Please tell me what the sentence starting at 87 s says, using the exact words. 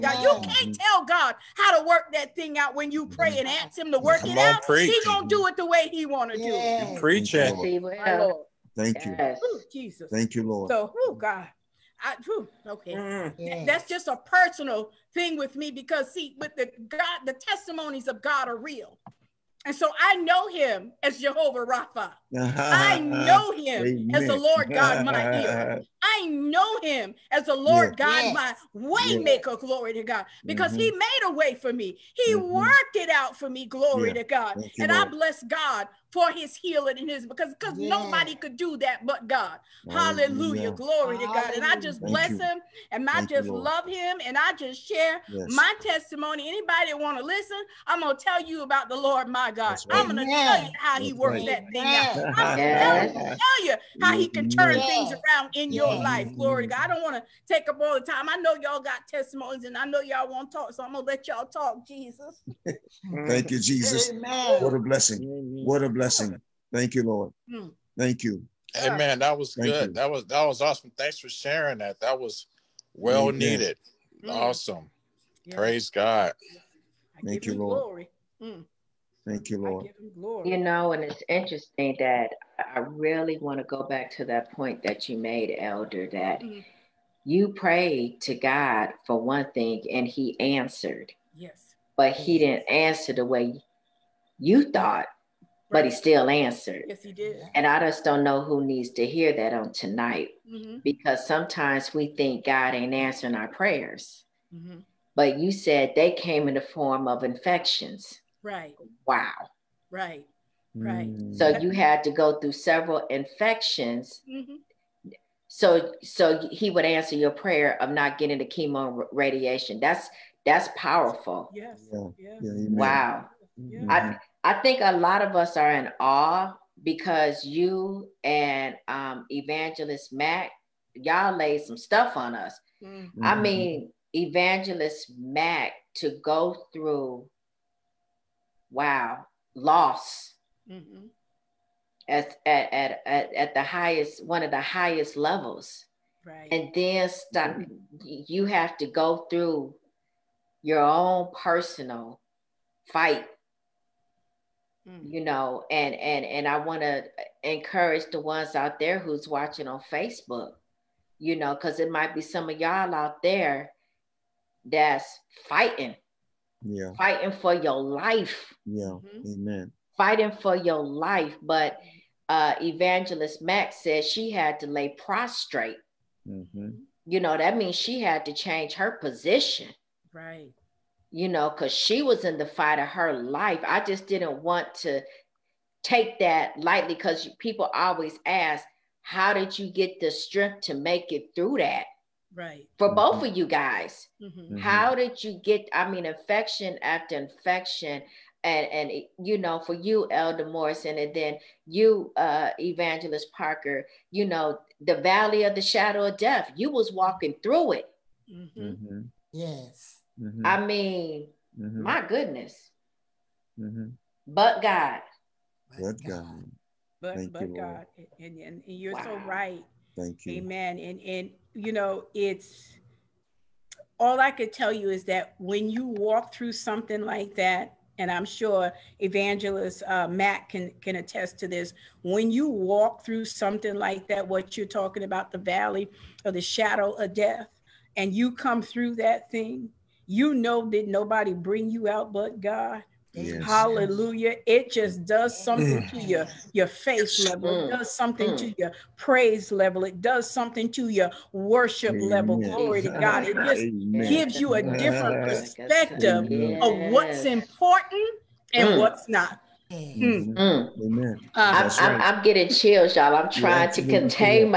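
you prayed to God for one thing and he answered.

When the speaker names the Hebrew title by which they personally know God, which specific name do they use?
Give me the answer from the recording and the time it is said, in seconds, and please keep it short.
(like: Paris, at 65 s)
Jehovah Rapha, at 21 s.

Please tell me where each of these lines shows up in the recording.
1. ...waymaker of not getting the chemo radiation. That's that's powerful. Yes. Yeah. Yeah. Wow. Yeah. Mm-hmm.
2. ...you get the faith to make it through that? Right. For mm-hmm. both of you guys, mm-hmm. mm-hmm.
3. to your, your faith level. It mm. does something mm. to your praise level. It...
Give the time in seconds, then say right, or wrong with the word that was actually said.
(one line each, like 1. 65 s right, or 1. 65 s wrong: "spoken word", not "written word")
1. 117 s wrong: "prayer", not "waymaker"
2. 189 s wrong: "strength", not "faith"
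3. 245 s right.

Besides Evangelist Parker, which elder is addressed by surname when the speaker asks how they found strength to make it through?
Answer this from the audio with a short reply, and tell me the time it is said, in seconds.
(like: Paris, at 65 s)
Elder Morrison, at 200 s.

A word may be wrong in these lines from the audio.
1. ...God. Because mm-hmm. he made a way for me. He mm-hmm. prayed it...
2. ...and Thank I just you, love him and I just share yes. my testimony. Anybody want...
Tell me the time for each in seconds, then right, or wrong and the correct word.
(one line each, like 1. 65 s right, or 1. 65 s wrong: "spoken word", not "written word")
1. 30 s wrong: "worked", not "prayed"
2. 42 s right.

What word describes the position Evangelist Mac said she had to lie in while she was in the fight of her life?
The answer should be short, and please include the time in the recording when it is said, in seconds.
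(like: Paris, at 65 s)
prostrate, at 175 s.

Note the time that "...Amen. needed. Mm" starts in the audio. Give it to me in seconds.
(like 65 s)
73 s.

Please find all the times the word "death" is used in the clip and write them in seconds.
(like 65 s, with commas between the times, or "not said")
206 s, 237 s.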